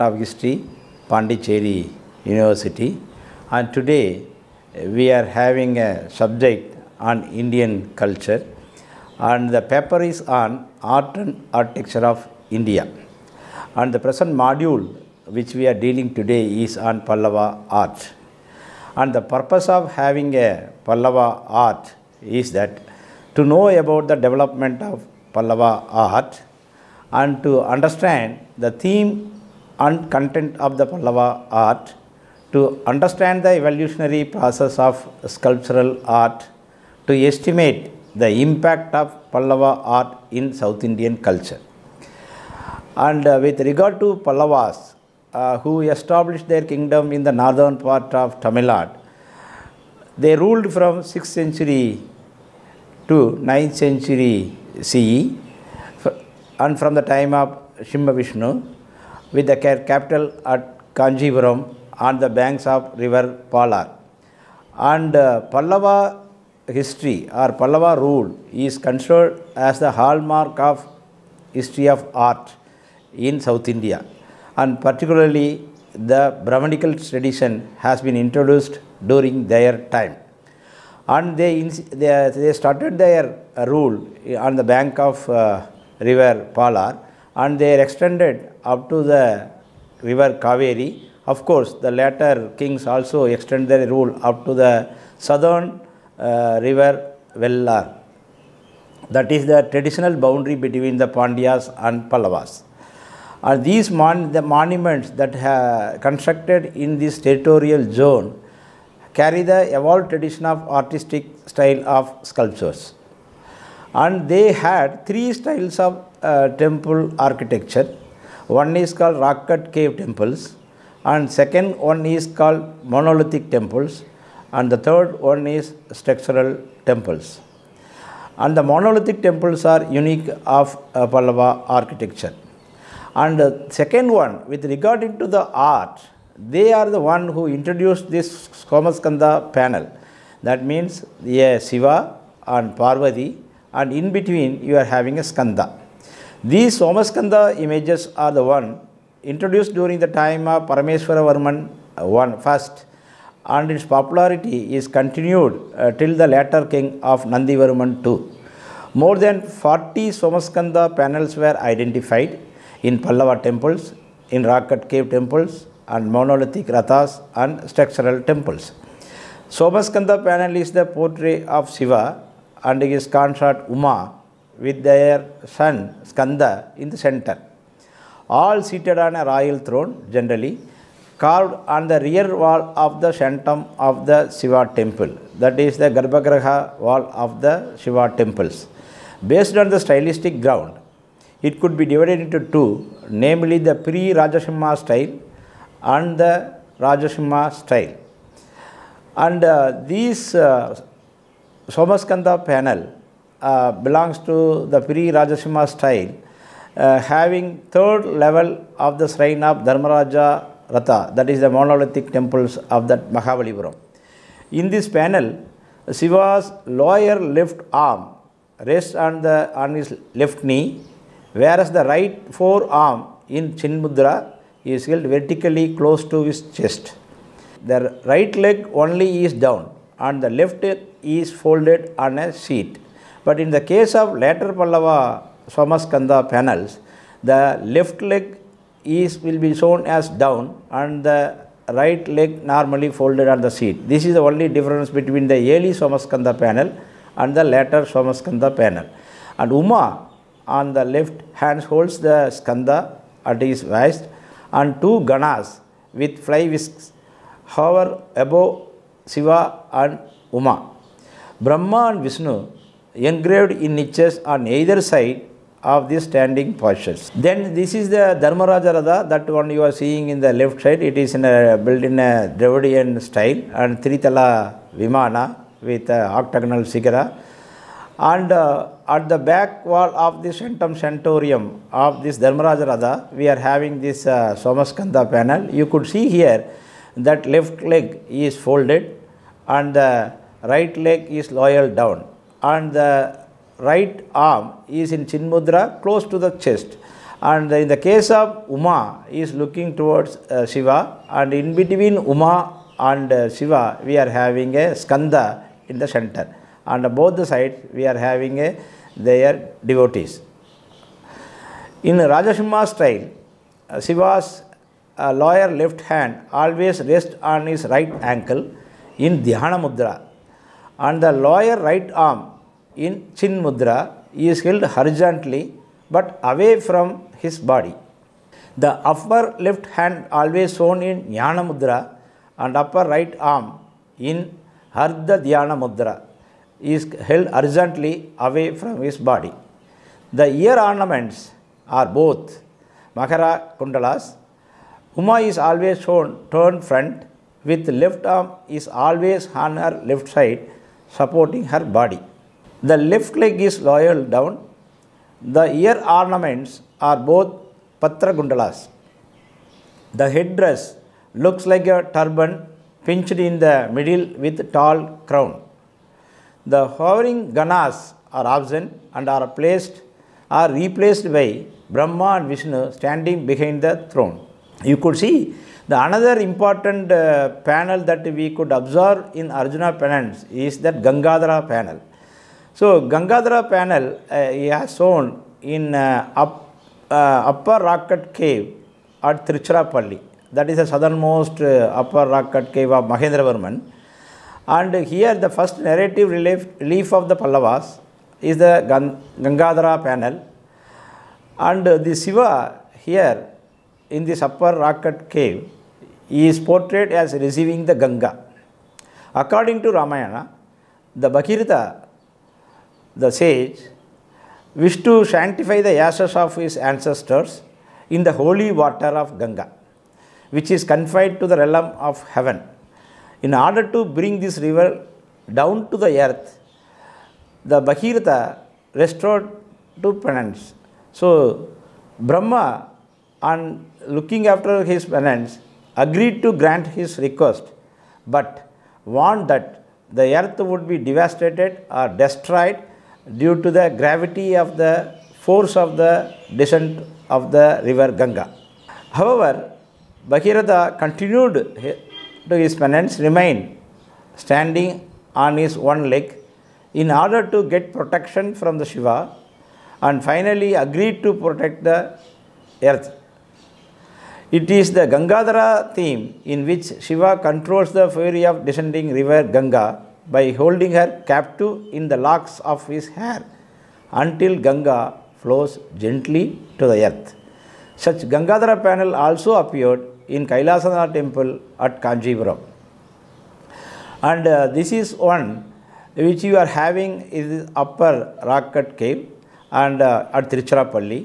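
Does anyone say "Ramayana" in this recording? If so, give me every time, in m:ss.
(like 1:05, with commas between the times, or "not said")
6:49.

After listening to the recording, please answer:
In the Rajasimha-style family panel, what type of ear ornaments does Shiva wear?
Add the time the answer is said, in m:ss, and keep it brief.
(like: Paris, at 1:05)
Makara Kundalas, at 5:42.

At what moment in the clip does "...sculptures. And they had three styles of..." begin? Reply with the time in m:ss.
1:52.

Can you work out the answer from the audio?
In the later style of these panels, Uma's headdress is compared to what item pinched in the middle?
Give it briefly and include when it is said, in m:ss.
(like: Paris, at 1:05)
A turban, at 6:01.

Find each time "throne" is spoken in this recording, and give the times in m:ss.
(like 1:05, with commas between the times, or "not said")
2:59, 6:13.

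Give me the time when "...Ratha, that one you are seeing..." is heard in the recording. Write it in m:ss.
4:28.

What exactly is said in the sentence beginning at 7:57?
Such Gangadhara panel also appeared in Kailasanath temple at Kanjipuram.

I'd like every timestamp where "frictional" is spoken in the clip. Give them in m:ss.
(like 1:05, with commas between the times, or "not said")
not said.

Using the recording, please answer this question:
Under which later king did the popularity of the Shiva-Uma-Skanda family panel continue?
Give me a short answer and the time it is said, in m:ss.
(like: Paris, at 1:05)
Nandivarman II, at 2:37.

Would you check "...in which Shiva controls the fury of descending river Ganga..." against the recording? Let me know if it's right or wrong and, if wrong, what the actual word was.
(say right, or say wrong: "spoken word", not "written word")
right.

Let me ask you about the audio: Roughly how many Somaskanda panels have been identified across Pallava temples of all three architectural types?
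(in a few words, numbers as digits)
More than 40.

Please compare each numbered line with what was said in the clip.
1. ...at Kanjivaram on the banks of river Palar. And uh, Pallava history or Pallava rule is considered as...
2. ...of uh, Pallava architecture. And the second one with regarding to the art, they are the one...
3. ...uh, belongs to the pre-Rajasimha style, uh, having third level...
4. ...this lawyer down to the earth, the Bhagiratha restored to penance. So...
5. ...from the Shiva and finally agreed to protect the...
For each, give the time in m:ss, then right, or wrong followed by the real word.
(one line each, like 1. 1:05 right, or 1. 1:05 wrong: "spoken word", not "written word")
1. 1:00 right
2. 2:10 right
3. 3:23 right
4. 7:04 wrong: "river", not "lawyer"
5. 7:38 right.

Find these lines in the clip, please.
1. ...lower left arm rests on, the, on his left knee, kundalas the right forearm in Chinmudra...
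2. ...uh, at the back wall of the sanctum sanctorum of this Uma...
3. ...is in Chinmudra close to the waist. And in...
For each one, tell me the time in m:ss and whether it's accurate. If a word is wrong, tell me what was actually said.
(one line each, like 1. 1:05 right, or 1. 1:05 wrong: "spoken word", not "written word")
1. 3:36 wrong: "whereas", not "kundalas"
2. 4:38 wrong: "Dharmaraja", not "Uma"
3. 4:54 wrong: "chest", not "waist".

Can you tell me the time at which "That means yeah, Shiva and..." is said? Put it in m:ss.
2:20.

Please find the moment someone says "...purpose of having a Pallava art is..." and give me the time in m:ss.
0:19.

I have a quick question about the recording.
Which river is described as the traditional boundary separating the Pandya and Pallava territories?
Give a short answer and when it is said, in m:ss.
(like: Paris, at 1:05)
Vellar, at 1:37.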